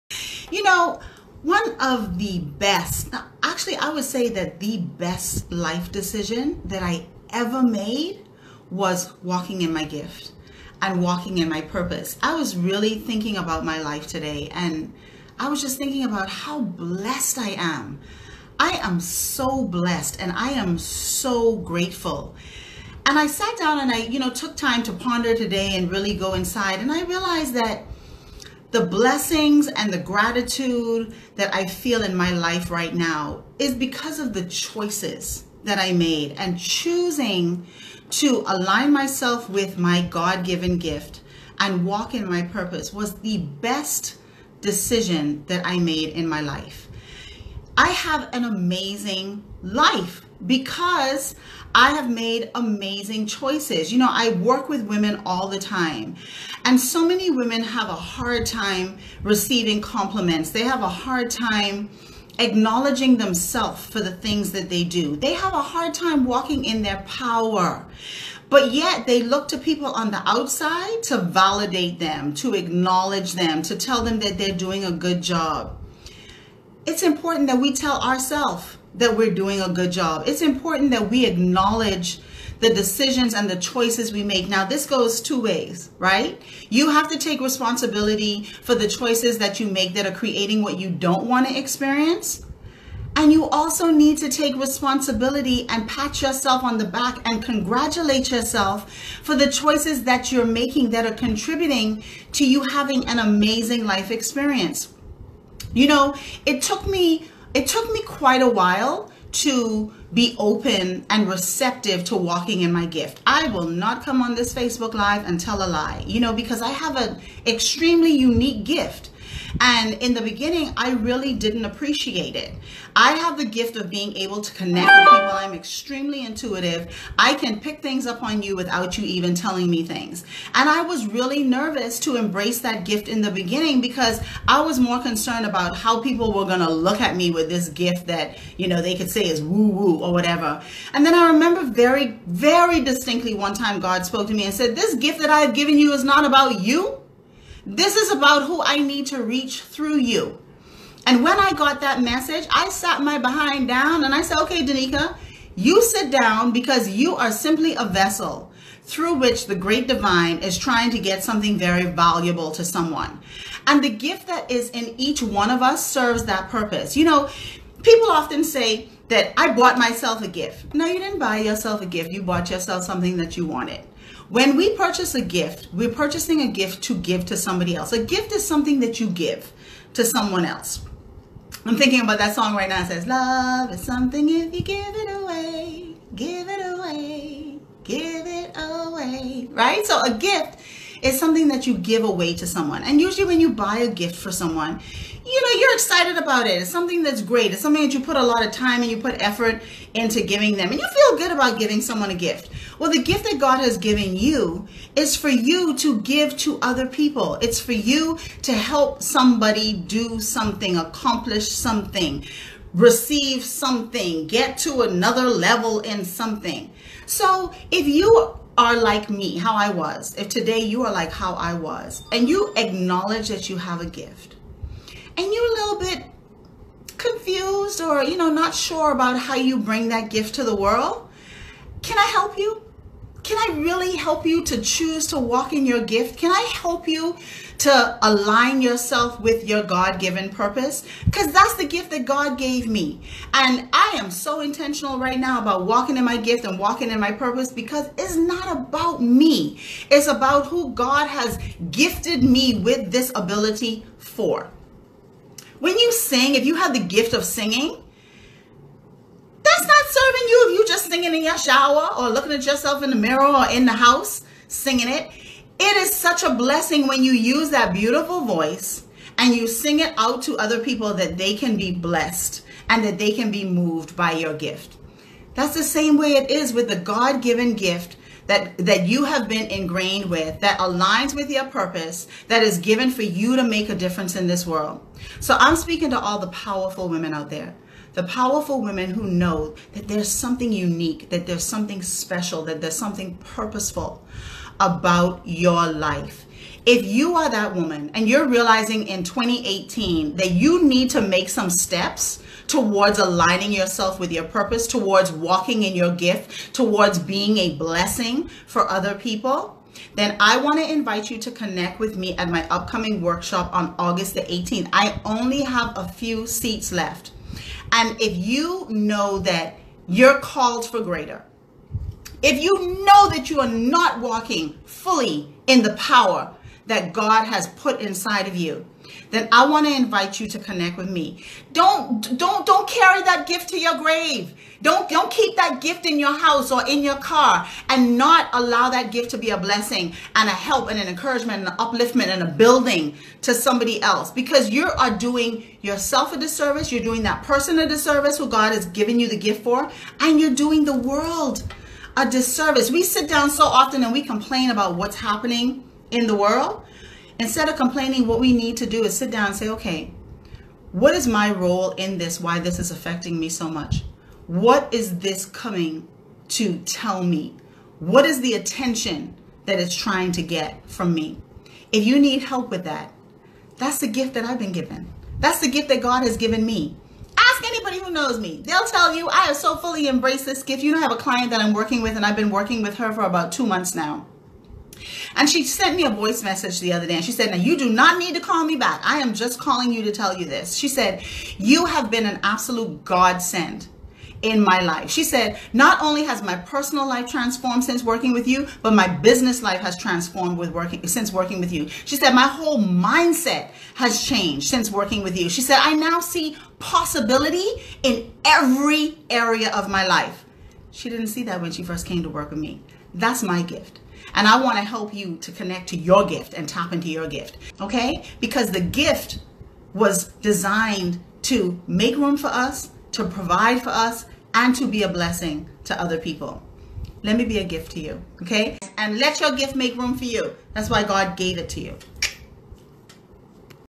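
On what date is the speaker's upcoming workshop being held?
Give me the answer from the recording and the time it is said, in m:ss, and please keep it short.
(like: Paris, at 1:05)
August 18, at 5:13.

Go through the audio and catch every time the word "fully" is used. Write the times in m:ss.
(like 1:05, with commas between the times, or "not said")
5:24, 6:19.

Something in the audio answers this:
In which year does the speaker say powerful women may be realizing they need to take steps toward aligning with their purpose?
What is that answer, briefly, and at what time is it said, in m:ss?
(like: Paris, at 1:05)
2018, at 4:59.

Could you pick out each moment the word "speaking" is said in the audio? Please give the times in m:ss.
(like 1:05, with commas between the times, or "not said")
4:45.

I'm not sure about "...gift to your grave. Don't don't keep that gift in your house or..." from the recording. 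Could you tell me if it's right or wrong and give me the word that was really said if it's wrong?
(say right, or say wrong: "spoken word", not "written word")
right.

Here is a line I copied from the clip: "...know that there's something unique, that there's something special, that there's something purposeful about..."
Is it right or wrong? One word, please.
right.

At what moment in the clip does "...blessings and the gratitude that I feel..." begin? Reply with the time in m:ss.
0:28.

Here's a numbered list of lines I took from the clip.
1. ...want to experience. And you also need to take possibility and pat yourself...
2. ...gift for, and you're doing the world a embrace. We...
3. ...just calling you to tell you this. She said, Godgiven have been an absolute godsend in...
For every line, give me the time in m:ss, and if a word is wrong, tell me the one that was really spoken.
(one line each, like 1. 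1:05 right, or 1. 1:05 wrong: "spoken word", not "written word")
1. 1:31 wrong: "responsibility", not "possibility"
2. 5:49 wrong: "disservice", not "embrace"
3. 6:29 wrong: "You", not "Godgiven".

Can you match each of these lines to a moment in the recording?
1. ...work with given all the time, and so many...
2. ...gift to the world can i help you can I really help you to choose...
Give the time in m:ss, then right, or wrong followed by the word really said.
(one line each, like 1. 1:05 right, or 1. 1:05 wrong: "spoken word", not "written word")
1. 0:54 wrong: "women", not "given"
2. 3:50 right.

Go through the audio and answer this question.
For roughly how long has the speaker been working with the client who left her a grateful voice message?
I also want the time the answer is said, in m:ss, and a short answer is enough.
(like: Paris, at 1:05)
about 2 months, at 6:23.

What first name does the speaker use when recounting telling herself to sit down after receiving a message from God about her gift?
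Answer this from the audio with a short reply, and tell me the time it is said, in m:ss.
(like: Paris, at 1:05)
Denika, at 2:34.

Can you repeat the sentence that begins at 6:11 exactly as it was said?
If you need help with that, that's the gift that I've been given.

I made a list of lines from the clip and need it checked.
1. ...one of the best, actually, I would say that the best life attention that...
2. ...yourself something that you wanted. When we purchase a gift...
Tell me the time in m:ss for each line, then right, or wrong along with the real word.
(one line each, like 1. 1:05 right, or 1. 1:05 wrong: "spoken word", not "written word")
1. 0:01 wrong: "decision", not "attention"
2. 2:52 right.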